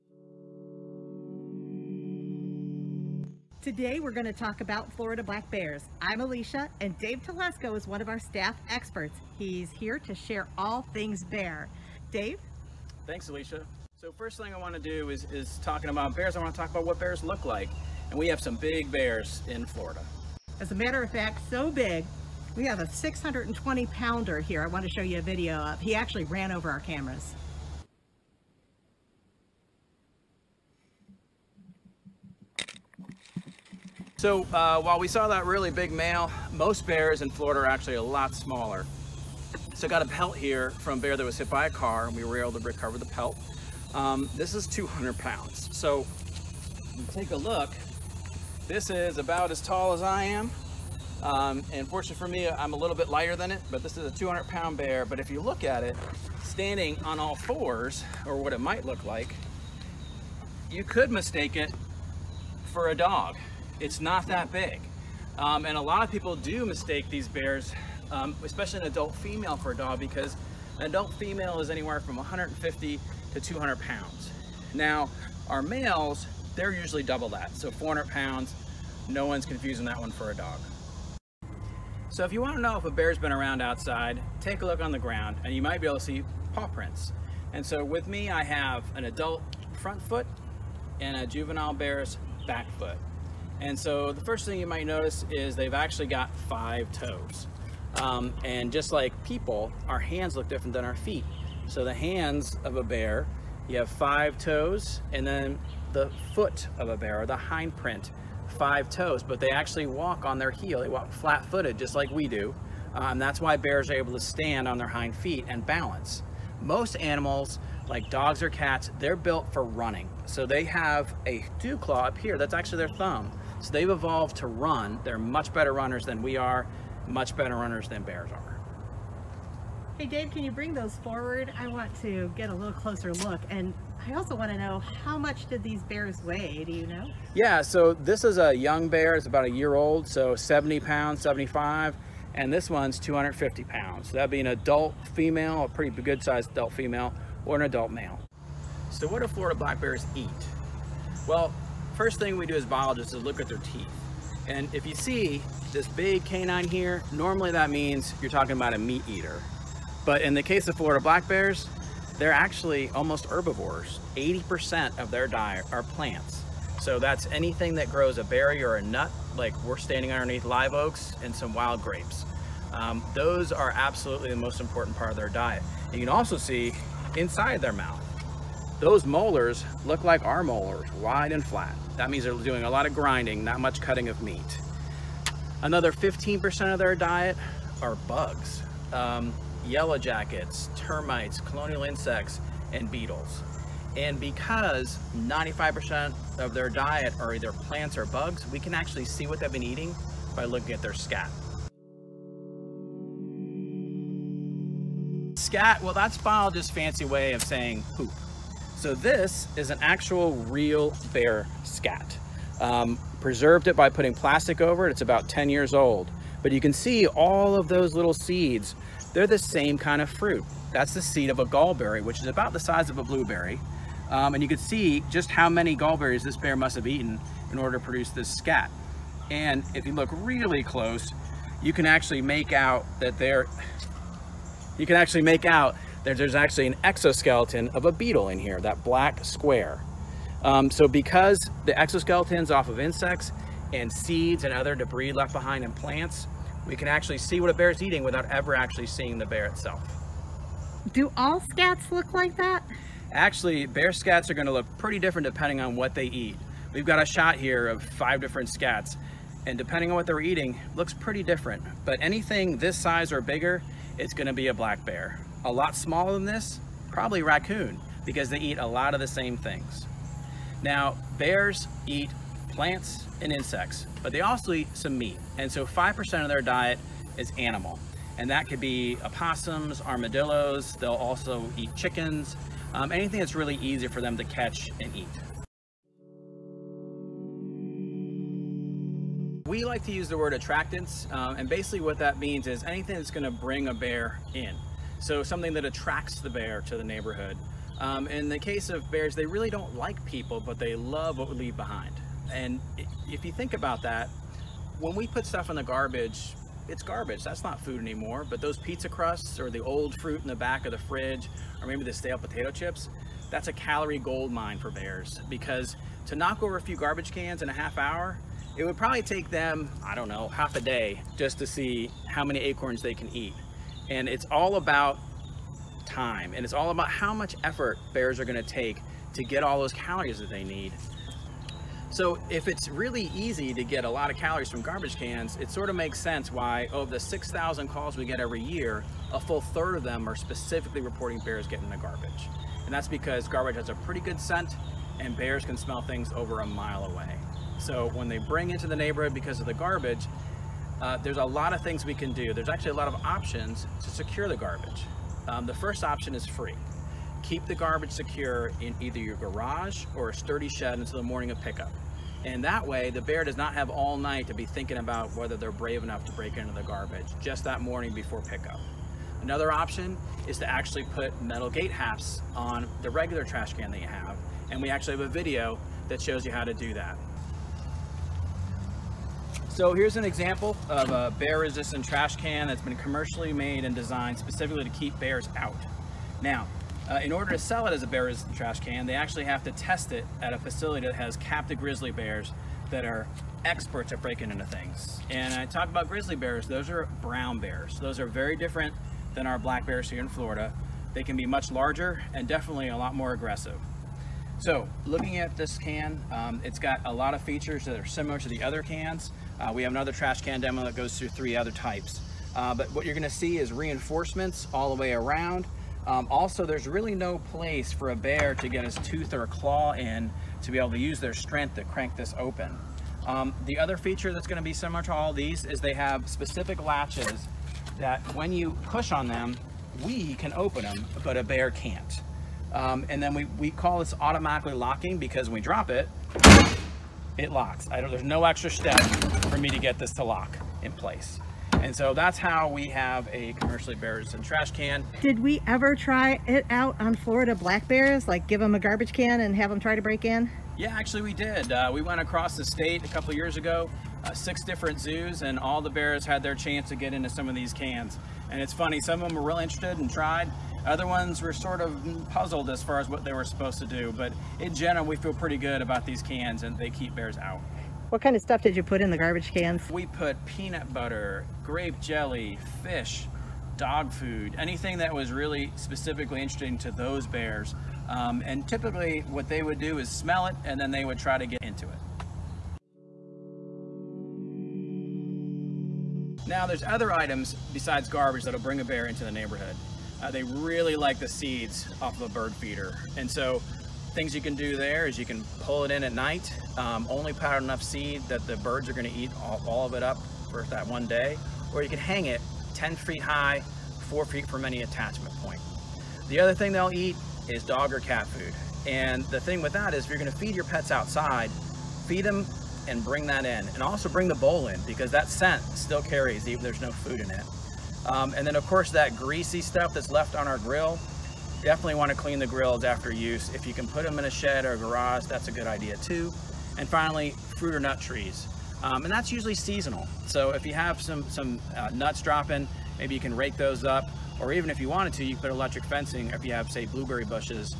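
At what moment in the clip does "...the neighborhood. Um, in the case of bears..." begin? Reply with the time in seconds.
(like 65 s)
296 s.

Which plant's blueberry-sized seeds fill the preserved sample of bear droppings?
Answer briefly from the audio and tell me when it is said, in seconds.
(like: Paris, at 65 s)
gallberry, at 221 s.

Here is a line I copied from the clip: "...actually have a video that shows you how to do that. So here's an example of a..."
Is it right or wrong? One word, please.
right.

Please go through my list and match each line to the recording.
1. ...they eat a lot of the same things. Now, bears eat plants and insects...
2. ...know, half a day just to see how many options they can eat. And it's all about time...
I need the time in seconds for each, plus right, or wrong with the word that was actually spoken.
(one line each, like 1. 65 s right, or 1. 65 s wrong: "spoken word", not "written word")
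1. 268 s right
2. 320 s wrong: "acorns", not "options".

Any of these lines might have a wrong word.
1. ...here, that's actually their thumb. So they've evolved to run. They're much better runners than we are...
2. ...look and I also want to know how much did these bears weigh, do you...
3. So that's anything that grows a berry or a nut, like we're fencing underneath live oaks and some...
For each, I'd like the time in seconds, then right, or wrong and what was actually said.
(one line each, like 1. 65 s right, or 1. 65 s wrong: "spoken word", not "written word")
1. 122 s right
2. 133 s right
3. 166 s wrong: "standing", not "fencing".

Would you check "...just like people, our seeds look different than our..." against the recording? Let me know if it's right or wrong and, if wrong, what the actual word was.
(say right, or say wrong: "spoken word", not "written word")
wrong: "hands", not "seeds".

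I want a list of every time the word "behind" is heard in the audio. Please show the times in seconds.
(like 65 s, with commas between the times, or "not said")
245 s, 301 s.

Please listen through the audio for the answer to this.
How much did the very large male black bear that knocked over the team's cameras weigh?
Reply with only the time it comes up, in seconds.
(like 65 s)
22 s.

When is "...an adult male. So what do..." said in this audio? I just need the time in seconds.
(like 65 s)
147 s.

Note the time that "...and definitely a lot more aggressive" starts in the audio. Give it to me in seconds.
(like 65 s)
402 s.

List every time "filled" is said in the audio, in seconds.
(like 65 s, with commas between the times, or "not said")
not said.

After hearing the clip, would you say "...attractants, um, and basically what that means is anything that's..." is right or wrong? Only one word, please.
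right.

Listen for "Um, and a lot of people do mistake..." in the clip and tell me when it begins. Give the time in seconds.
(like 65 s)
65 s.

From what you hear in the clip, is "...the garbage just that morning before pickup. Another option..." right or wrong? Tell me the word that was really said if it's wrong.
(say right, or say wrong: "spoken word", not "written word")
right.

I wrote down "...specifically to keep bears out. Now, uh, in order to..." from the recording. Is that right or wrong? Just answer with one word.
right.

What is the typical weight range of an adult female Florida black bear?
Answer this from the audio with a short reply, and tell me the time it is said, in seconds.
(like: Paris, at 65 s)
150 to 200 pounds, at 72 s.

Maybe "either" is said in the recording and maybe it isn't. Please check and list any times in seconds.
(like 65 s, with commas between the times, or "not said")
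197 s, 358 s.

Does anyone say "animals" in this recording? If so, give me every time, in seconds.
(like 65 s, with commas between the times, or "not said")
116 s, 277 s.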